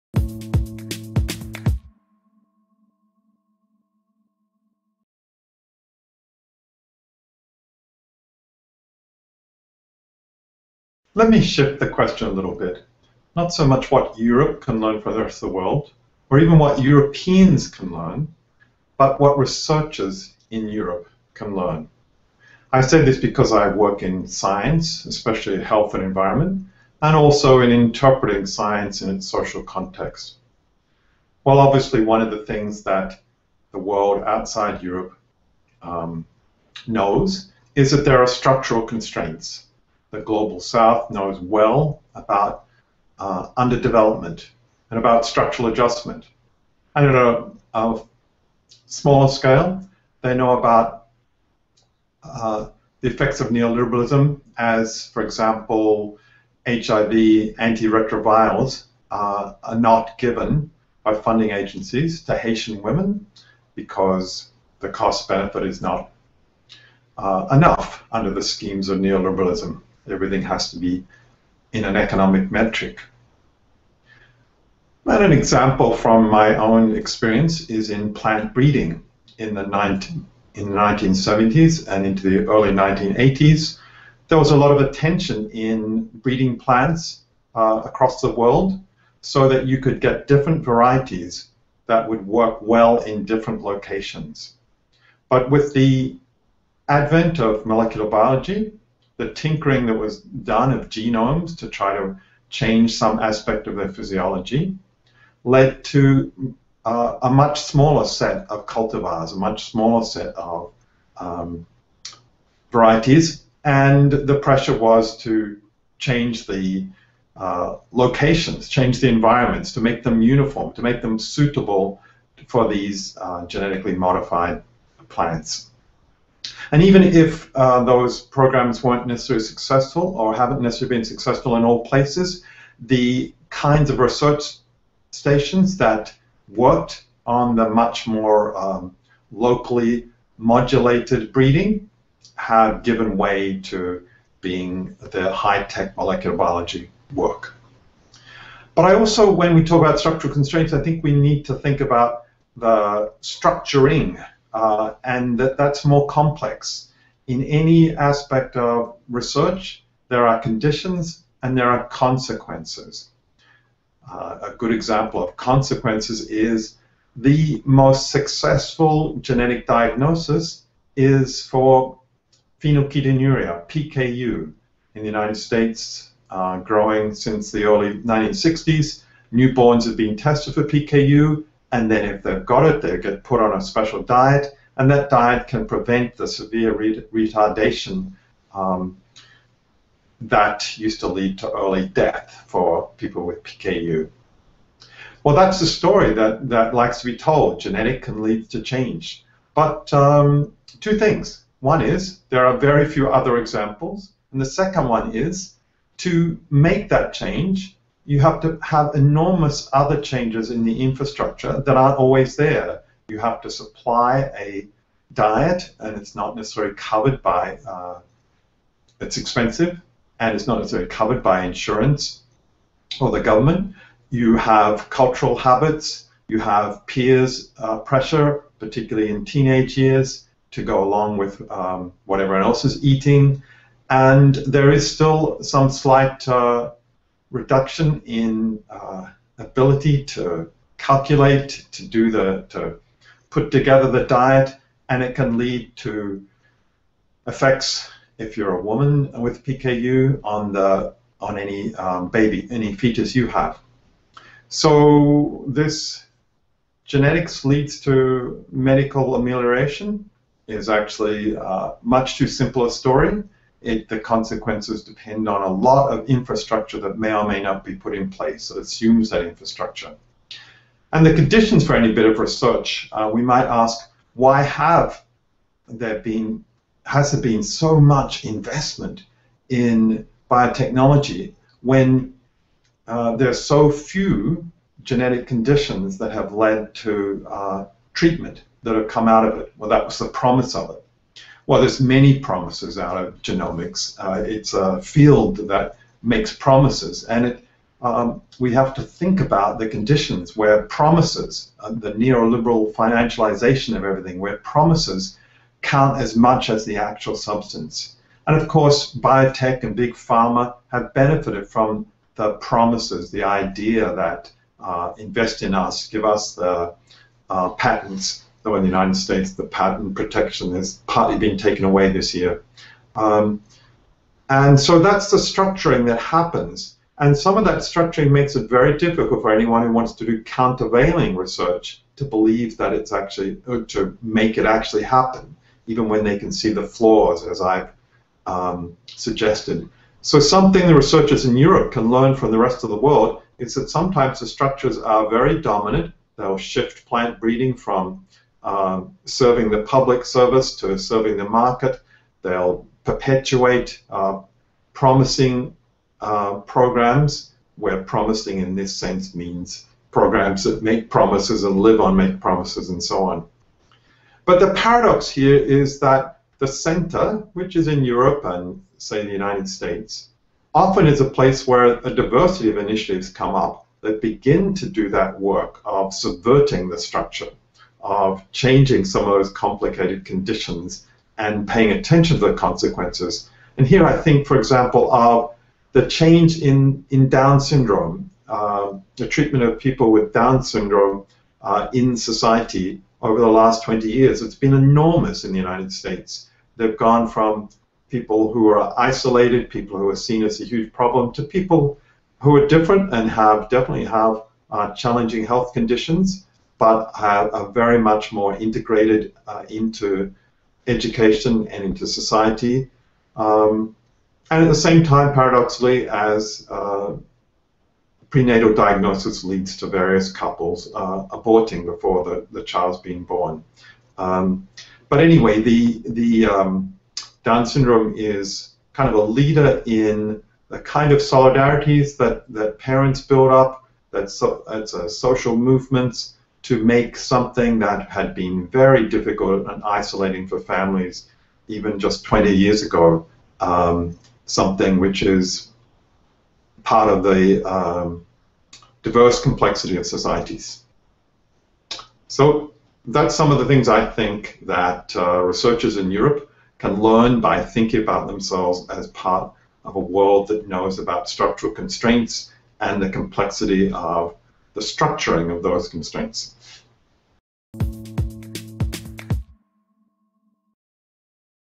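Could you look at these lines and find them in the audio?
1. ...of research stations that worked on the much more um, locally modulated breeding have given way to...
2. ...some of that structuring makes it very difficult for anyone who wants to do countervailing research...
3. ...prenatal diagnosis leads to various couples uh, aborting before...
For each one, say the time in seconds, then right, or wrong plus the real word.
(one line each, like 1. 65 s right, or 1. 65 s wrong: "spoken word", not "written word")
1. 133 s right
2. 327 s right
3. 418 s right.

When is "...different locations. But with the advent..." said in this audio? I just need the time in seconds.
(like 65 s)
93 s.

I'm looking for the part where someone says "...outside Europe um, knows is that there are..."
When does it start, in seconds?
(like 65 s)
34 s.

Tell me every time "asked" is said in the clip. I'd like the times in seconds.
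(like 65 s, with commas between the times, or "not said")
not said.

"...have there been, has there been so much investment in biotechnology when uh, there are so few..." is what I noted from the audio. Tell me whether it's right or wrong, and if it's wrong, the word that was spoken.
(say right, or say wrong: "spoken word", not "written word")
right.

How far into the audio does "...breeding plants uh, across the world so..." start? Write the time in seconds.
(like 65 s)
86 s.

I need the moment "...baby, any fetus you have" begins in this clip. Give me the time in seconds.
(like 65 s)
252 s.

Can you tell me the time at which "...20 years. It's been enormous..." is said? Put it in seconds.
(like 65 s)
393 s.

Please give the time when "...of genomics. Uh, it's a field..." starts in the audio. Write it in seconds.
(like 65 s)
292 s.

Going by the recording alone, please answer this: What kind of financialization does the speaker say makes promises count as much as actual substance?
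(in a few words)
Neoliberal financialization.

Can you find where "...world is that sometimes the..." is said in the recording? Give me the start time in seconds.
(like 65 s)
342 s.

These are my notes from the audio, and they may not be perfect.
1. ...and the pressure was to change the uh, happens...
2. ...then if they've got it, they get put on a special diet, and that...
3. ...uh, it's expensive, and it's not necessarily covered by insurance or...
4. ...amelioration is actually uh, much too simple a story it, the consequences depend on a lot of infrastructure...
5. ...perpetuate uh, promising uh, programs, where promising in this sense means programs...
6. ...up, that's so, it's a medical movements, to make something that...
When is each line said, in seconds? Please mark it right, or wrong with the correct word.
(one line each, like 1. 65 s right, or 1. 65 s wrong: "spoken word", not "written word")
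1. 113 s wrong: "locations", not "happens"
2. 181 s right
3. 217 s right
4. 259 s right
5. 352 s right
6. 433 s wrong: "social", not "medical".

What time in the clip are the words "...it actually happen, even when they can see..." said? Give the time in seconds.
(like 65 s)
334 s.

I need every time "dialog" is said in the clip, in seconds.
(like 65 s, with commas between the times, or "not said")
not said.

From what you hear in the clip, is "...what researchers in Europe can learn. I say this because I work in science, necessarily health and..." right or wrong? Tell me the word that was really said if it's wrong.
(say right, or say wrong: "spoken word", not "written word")
wrong: "especially", not "necessarily".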